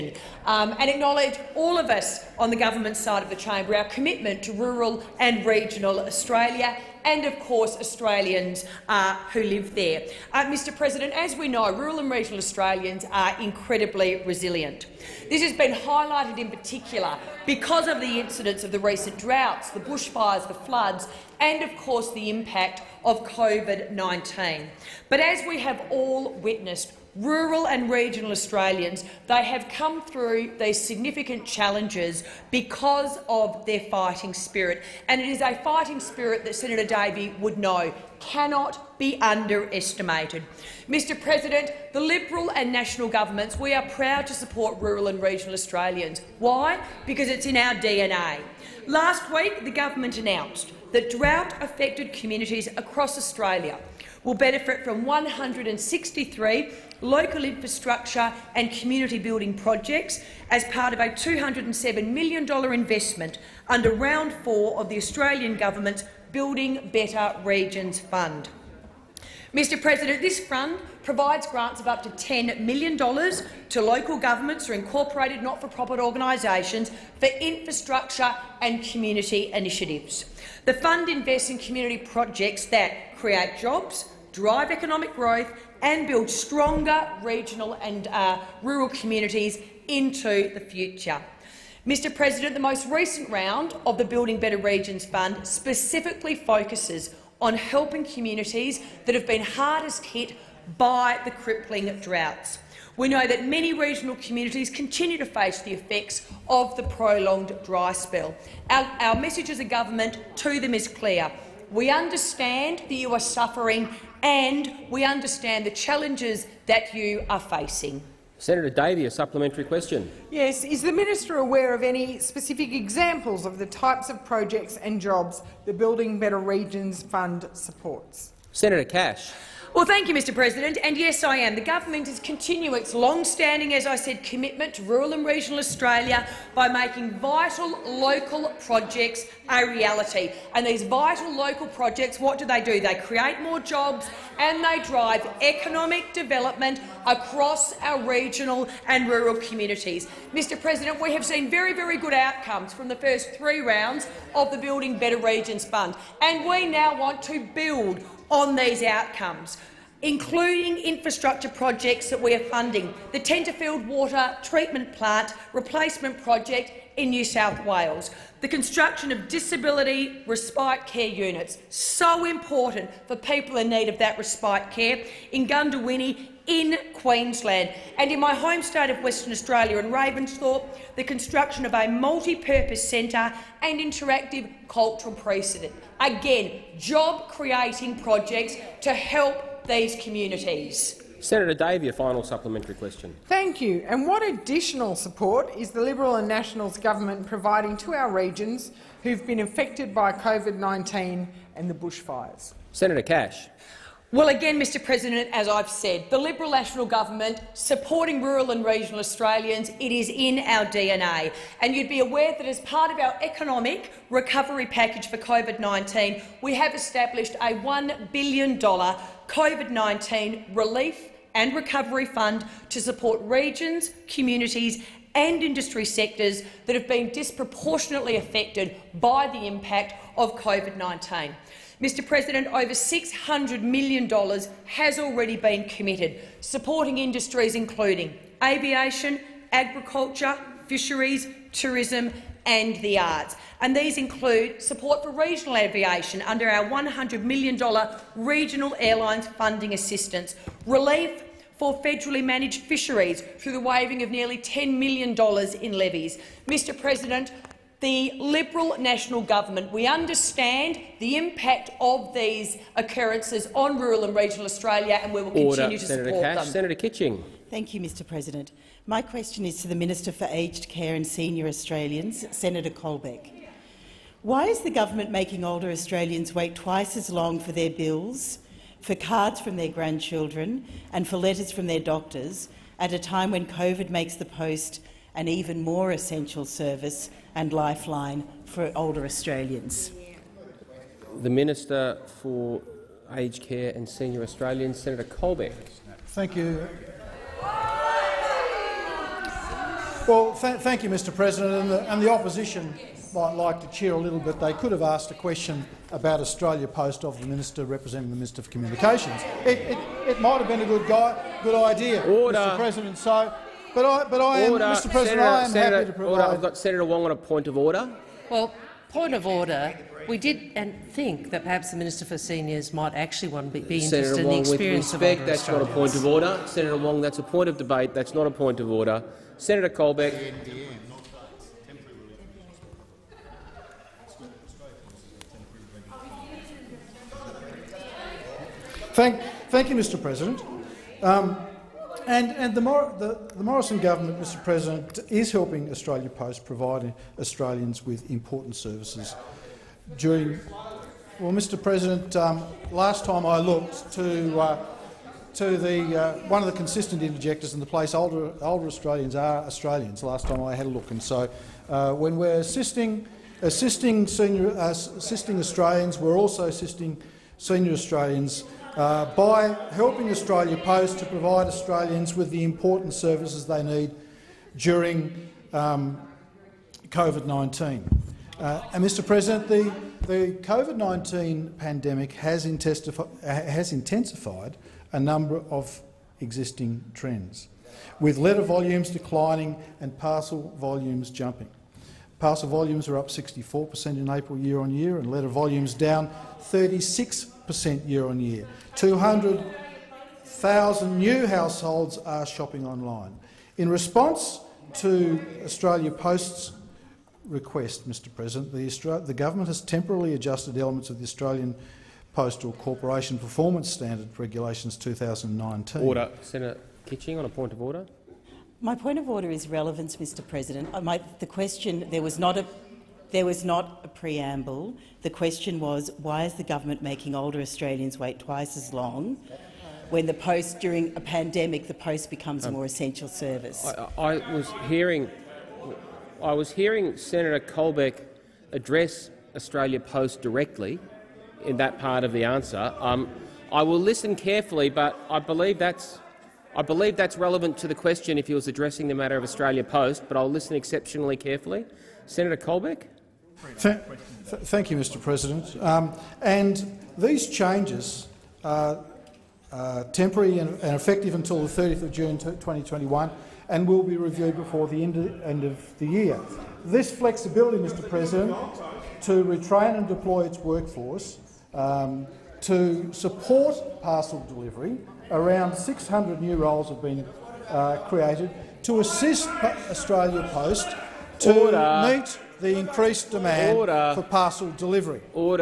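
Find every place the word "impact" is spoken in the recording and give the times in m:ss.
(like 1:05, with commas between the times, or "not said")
0:22, 3:49, 4:21.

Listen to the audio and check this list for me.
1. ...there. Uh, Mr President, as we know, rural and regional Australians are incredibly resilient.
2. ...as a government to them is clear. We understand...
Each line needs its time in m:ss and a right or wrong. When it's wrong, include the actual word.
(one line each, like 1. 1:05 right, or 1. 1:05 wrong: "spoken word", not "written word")
1. 0:09 right
2. 1:49 right.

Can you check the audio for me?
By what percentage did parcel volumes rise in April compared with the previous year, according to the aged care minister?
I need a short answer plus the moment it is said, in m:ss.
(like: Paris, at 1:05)
64 per cent, at 6:33.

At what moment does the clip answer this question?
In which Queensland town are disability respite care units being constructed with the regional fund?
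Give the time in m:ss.
2:55.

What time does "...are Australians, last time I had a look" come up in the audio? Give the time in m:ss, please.
5:59.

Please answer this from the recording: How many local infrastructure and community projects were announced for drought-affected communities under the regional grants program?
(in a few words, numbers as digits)
163.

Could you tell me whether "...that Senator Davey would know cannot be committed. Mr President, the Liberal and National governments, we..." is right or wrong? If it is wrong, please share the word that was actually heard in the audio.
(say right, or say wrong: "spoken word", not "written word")
wrong: "underestimated", not "committed".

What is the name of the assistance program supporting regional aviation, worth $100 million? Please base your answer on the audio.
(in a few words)
Regional Airlines Funding Assistance.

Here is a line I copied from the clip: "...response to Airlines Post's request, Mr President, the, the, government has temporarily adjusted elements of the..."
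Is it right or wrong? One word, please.
wrong.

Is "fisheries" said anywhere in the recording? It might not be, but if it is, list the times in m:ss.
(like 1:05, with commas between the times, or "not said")
4:00, 4:12.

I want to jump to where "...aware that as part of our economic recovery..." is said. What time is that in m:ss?
3:31.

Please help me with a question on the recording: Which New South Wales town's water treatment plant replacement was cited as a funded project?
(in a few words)
Tenterfield.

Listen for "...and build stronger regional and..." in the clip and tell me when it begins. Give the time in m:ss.
1:25.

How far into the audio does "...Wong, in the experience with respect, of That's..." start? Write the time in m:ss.
5:24.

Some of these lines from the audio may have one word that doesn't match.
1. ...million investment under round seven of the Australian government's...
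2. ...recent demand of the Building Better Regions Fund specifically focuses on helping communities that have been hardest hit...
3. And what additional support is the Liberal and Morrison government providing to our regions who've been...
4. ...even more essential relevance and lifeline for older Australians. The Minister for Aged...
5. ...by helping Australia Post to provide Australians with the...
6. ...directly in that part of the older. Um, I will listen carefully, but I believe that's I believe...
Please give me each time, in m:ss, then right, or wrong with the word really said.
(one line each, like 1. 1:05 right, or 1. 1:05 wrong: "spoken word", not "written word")
1. 1:02 wrong: "four", not "seven"
2. 1:32 wrong: "round", not "demand"
3. 3:13 wrong: "Nationals", not "Morrison"
4. 4:45 wrong: "service", not "relevance"
5. 6:09 right
6. 7:20 wrong: "answer", not "older".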